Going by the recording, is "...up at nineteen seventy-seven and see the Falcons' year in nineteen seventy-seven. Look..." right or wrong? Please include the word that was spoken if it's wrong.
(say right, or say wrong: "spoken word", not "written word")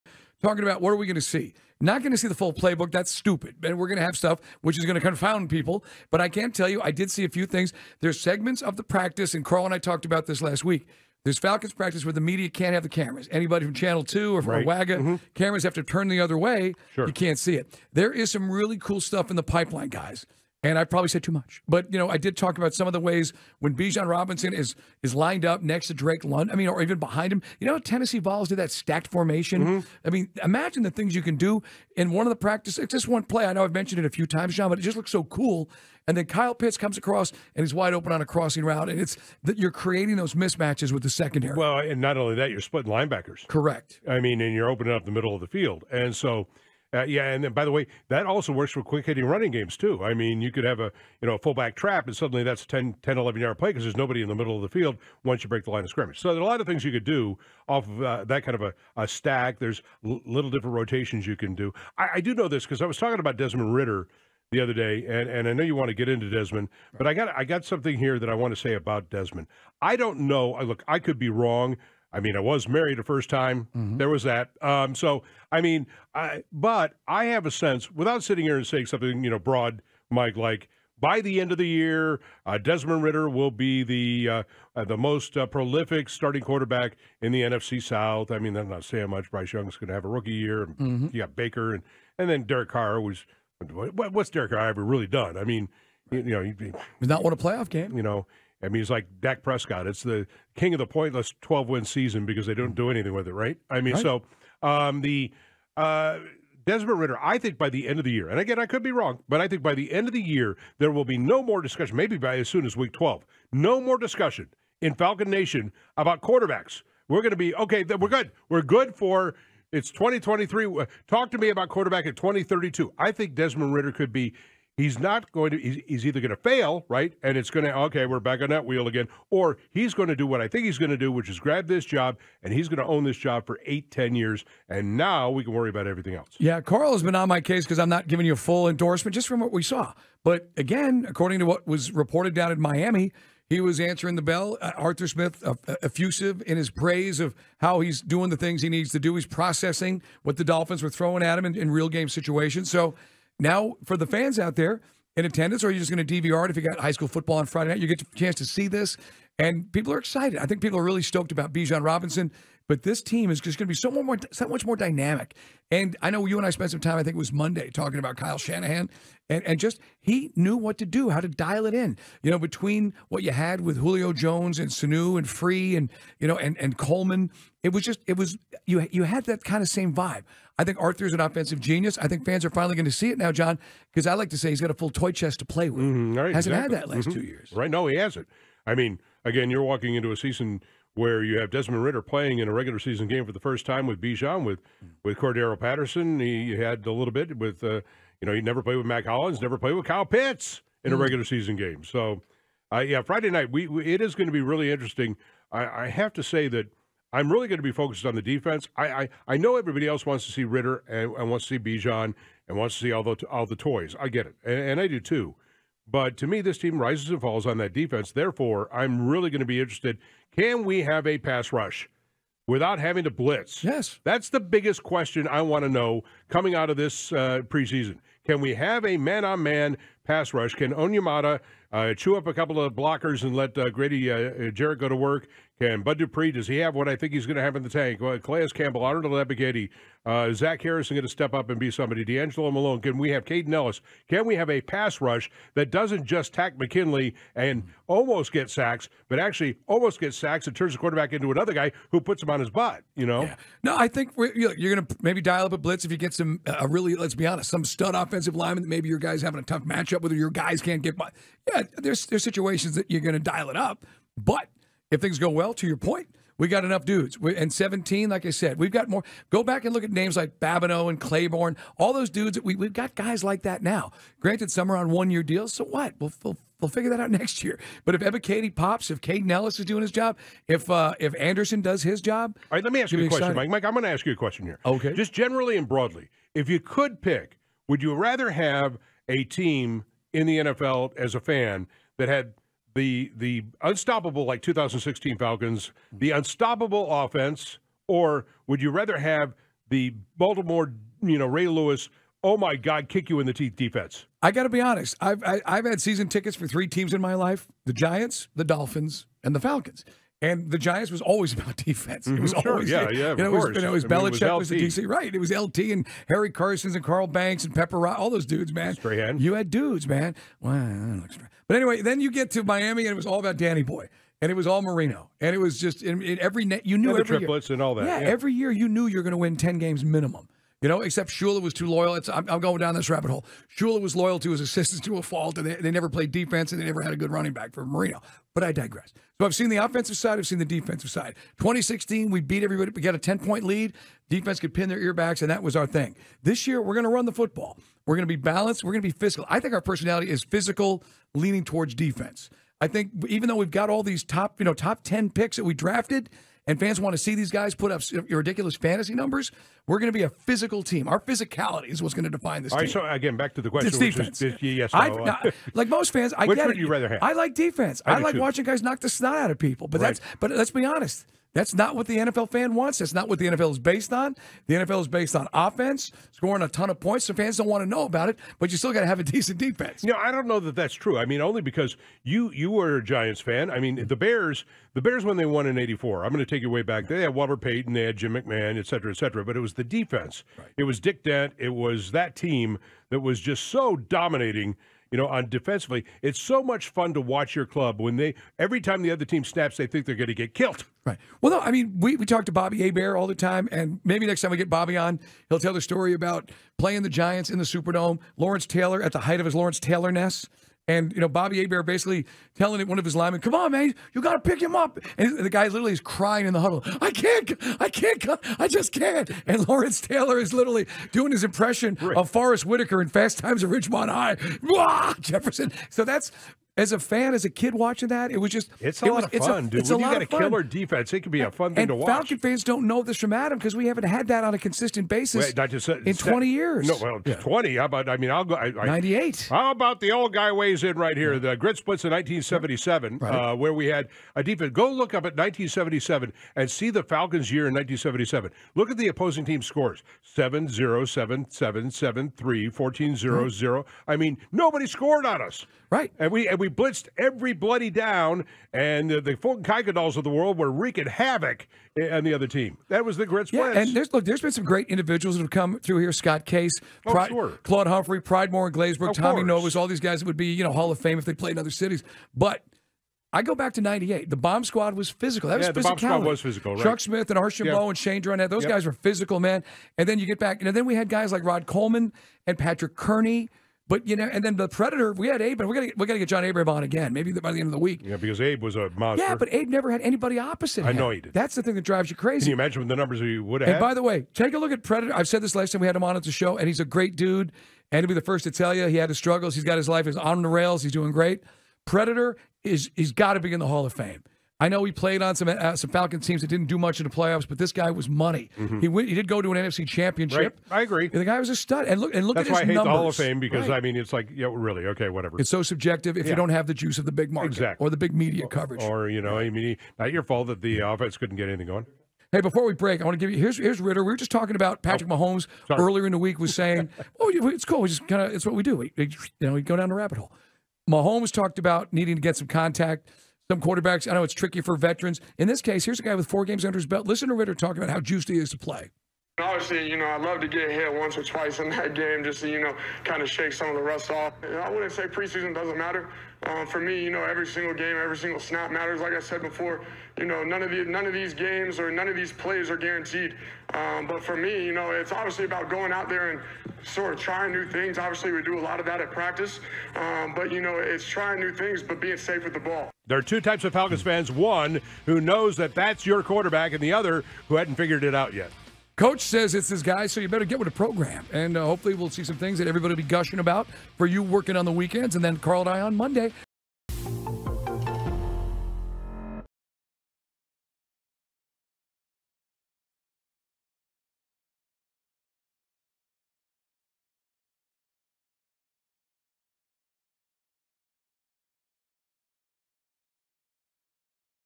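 right.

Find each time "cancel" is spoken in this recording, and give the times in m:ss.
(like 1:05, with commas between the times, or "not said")
not said.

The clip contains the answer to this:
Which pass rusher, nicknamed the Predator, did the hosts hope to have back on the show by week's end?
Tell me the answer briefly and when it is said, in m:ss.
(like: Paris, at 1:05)
John Abraham, at 8:06.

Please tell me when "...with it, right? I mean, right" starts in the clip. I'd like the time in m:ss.
1:43.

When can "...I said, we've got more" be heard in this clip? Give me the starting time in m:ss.
4:28.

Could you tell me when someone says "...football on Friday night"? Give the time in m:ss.
2:37.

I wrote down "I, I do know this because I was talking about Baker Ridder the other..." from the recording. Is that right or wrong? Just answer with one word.
wrong.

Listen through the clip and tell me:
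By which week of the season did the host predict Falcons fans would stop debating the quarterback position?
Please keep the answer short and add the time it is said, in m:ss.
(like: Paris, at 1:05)
week 12, at 1:52.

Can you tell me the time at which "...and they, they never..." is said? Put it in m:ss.
5:35.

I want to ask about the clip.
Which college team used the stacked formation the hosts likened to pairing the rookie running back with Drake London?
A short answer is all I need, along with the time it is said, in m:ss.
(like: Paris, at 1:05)
Tennessee Vols, at 0:27.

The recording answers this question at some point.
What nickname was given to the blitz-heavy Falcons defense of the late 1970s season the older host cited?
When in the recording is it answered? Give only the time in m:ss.
7:21.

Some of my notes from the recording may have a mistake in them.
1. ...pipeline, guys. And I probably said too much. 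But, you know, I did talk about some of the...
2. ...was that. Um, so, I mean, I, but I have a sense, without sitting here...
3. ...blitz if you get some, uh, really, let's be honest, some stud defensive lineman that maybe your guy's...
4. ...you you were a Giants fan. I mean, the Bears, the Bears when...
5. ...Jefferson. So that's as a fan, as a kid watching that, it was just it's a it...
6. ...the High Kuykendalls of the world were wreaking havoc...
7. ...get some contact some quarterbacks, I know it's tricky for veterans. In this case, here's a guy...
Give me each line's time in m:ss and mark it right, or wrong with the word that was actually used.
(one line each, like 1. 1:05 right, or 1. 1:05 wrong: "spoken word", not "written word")
1. 0:19 right
2. 1:14 right
3. 4:15 wrong: "offensive", not "defensive"
4. 6:22 right
5. 7:05 right
6. 7:38 wrong: "Fulton", not "High"
7. 8:52 right.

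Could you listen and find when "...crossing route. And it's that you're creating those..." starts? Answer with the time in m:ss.
0:38.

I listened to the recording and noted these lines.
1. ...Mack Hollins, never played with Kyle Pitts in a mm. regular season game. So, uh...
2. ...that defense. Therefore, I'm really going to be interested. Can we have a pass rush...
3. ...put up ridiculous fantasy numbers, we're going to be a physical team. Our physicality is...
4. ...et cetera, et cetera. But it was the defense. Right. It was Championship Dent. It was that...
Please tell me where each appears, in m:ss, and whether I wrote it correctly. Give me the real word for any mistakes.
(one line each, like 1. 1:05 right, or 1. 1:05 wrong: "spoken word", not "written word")
1. 3:18 right
2. 3:37 right
3. 5:57 right
4. 6:28 wrong: "Dick", not "Championship".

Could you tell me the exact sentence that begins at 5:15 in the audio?
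It was LT and Harry Carson's and Carl Banks and Pepper, Rye, all those dudes, man.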